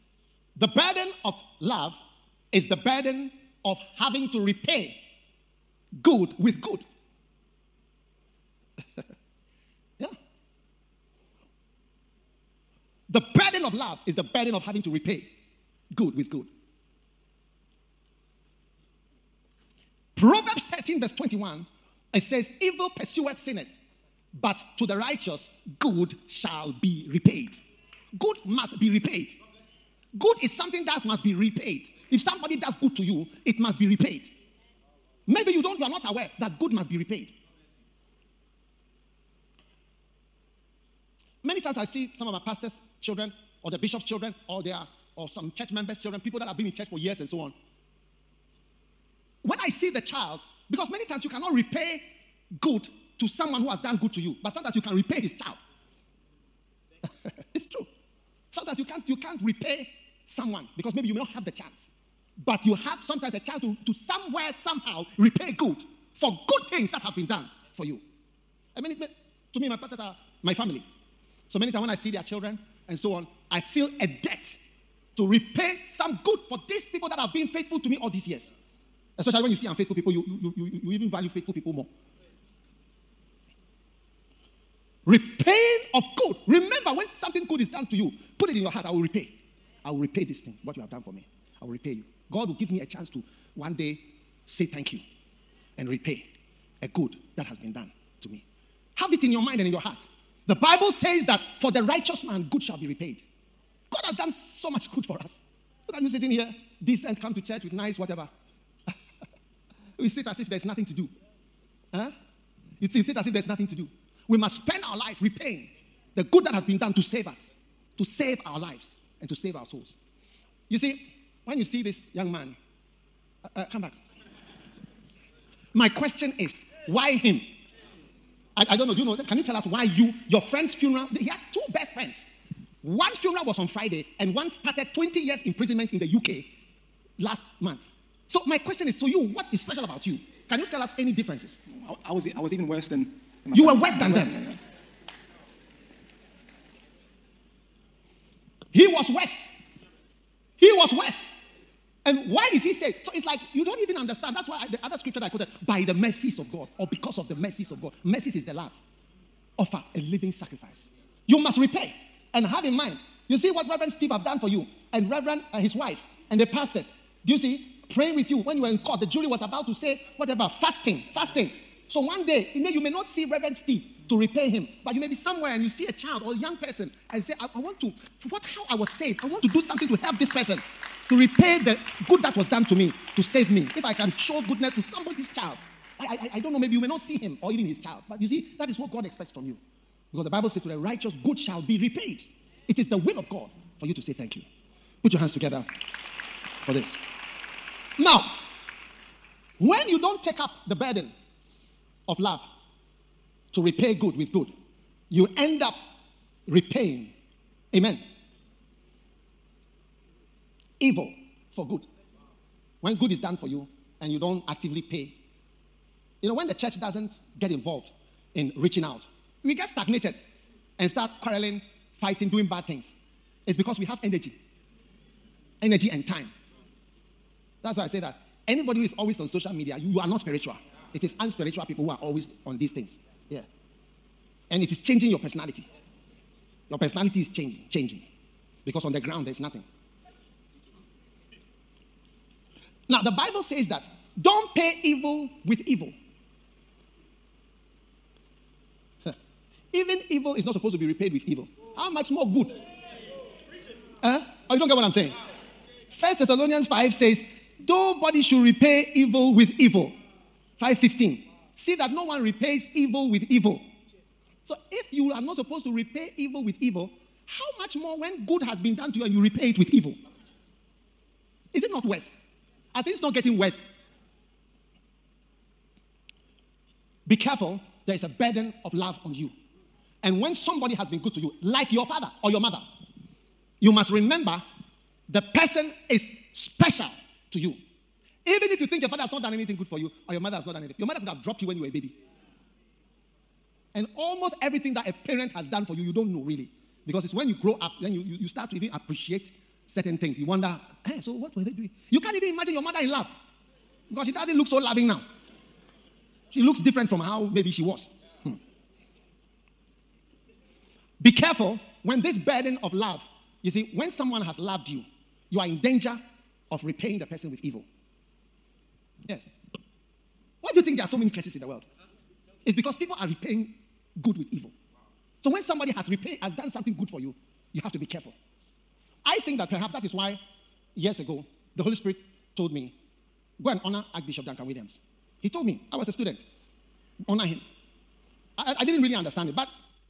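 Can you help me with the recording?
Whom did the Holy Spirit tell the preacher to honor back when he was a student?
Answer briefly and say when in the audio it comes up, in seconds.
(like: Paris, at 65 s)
Archbishop Duncan Williams, at 333 s.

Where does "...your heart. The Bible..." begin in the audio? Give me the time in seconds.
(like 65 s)
99 s.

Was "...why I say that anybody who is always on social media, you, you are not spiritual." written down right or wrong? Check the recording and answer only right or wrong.
right.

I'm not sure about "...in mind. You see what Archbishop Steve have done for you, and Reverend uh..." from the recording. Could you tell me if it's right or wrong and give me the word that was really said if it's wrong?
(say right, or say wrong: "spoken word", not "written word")
wrong: "Reverend", not "Archbishop".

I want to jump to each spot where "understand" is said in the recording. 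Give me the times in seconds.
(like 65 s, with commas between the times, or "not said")
153 s, 338 s.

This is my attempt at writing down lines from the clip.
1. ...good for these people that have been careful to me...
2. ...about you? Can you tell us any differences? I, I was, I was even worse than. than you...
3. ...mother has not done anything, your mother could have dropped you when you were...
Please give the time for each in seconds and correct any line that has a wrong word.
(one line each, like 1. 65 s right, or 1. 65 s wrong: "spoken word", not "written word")
1. 76 s wrong: "faithful", not "careful"
2. 139 s right
3. 290 s right.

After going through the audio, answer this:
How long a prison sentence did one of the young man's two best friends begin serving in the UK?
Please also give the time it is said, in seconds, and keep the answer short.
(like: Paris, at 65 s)
20 years, at 134 s.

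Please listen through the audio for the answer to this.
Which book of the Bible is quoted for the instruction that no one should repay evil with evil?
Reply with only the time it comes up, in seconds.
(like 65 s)
255 s.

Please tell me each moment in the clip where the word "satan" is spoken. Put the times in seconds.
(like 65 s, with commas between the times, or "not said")
not said.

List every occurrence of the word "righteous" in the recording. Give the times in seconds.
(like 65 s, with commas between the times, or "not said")
24 s, 101 s, 190 s.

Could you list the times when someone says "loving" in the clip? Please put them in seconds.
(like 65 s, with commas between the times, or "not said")
304 s.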